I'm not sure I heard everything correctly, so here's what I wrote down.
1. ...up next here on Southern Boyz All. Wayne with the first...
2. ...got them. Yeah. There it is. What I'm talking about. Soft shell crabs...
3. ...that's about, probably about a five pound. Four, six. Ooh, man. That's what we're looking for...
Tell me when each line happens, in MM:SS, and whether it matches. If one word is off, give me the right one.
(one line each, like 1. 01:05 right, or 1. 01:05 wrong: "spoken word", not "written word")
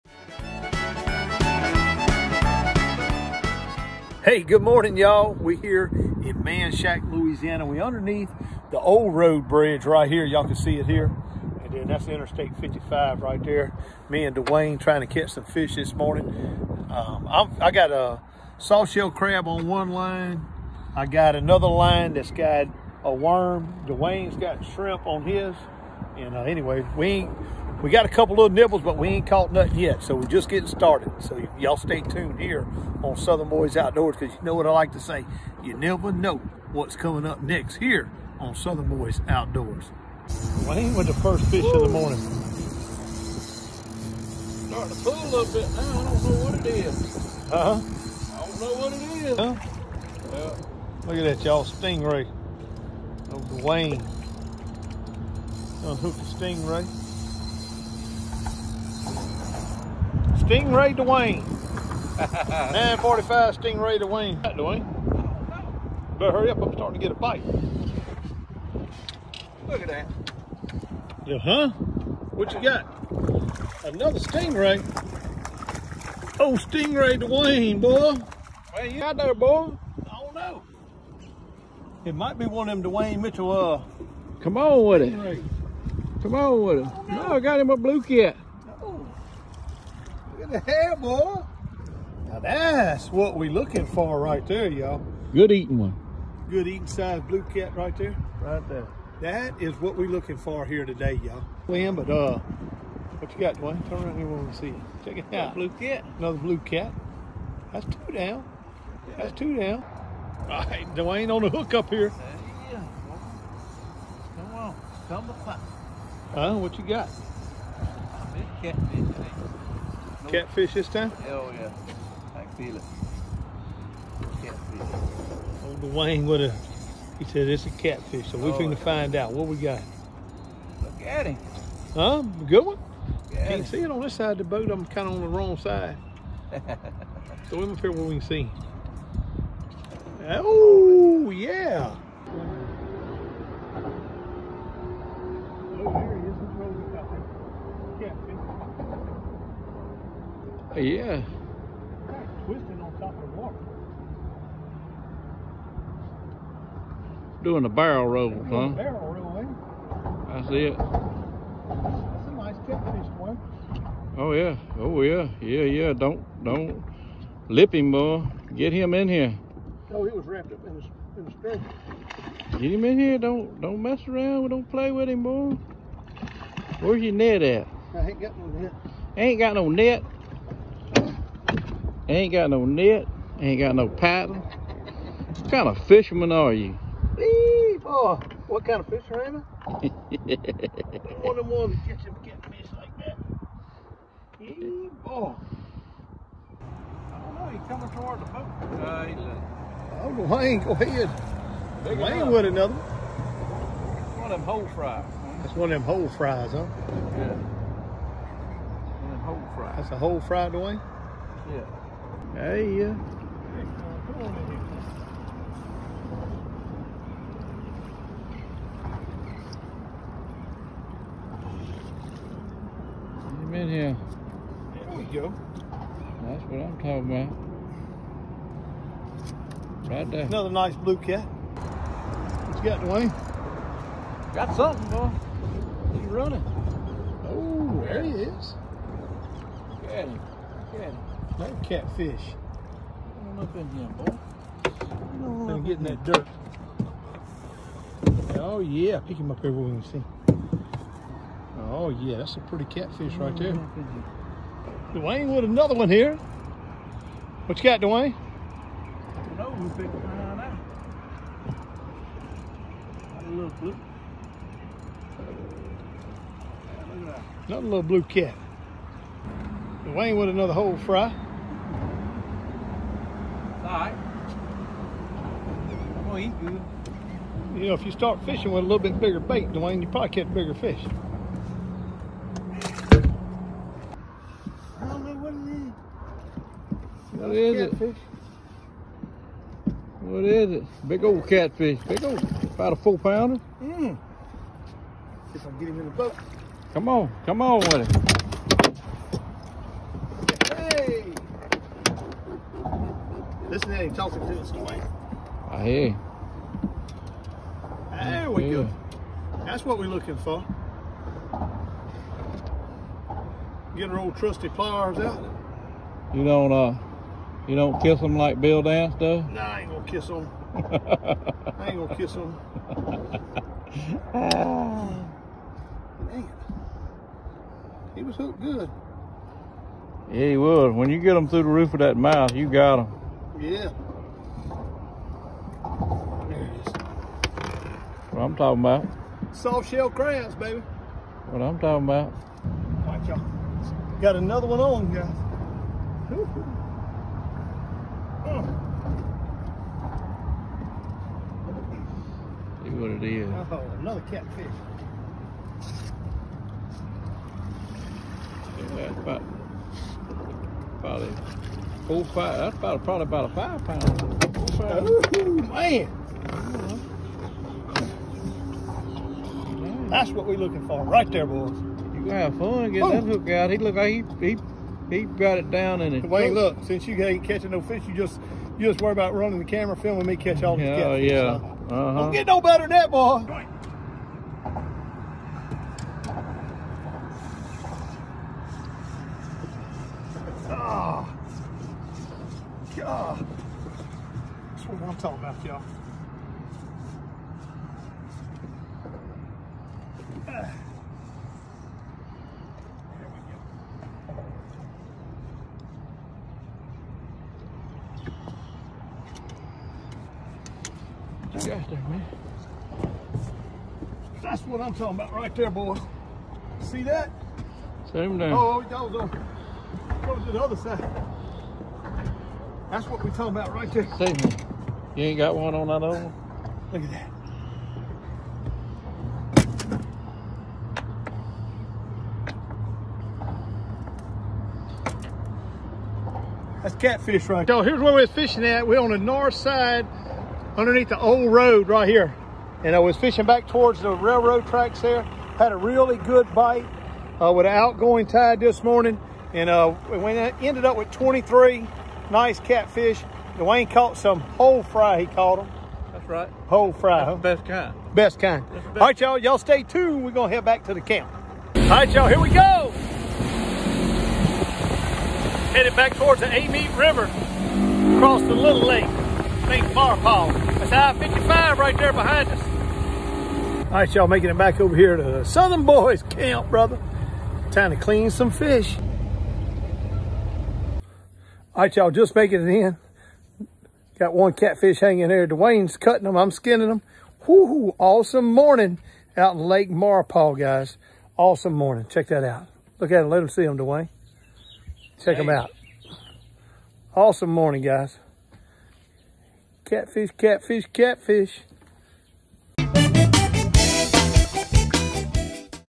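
1. 00:37 wrong: "Outdoors", not "All"
2. 05:32 right
3. 06:02 wrong: "five", not "six".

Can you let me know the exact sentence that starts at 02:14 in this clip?
I'm kind of on the wrong side.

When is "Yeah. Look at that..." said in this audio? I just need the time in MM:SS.
00:50.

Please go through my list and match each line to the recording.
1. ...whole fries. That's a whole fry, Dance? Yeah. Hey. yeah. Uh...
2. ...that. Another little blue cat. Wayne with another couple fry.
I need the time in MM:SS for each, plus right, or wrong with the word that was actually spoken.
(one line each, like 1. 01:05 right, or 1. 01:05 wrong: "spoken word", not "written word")
1. 03:29 wrong: "Dwayne", not "Dance"
2. 04:26 wrong: "whole", not "couple".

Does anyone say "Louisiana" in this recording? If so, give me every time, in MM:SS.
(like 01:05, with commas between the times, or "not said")
00:07.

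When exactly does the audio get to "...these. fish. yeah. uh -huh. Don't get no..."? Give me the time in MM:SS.
06:20.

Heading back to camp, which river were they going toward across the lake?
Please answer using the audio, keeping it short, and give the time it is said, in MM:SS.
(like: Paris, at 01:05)
Amite River, at 07:46.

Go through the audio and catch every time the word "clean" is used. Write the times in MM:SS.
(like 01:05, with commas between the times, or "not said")
07:57.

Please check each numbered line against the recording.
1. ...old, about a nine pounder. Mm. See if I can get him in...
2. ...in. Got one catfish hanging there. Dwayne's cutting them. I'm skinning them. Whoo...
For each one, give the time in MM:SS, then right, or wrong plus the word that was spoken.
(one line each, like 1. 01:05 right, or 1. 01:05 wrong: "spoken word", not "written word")
1. 04:52 wrong: "four", not "nine"
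2. 08:02 right.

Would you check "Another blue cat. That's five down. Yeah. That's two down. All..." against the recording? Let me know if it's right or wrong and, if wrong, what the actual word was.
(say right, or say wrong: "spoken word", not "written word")
wrong: "two", not "five".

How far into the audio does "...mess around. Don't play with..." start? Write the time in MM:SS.
02:53.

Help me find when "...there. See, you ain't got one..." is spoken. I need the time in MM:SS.
07:03.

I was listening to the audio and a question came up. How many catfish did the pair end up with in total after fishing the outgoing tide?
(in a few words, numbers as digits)
23.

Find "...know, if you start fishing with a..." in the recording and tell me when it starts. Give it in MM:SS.
04:37.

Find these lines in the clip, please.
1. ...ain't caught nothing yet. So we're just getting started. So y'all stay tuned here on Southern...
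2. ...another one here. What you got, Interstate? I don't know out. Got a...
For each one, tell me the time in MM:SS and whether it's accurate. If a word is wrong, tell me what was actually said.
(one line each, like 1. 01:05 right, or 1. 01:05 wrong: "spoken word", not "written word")
1. 00:29 right
2. 04:15 wrong: "Dwayne", not "Interstate".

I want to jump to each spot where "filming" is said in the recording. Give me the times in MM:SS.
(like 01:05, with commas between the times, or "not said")
06:19.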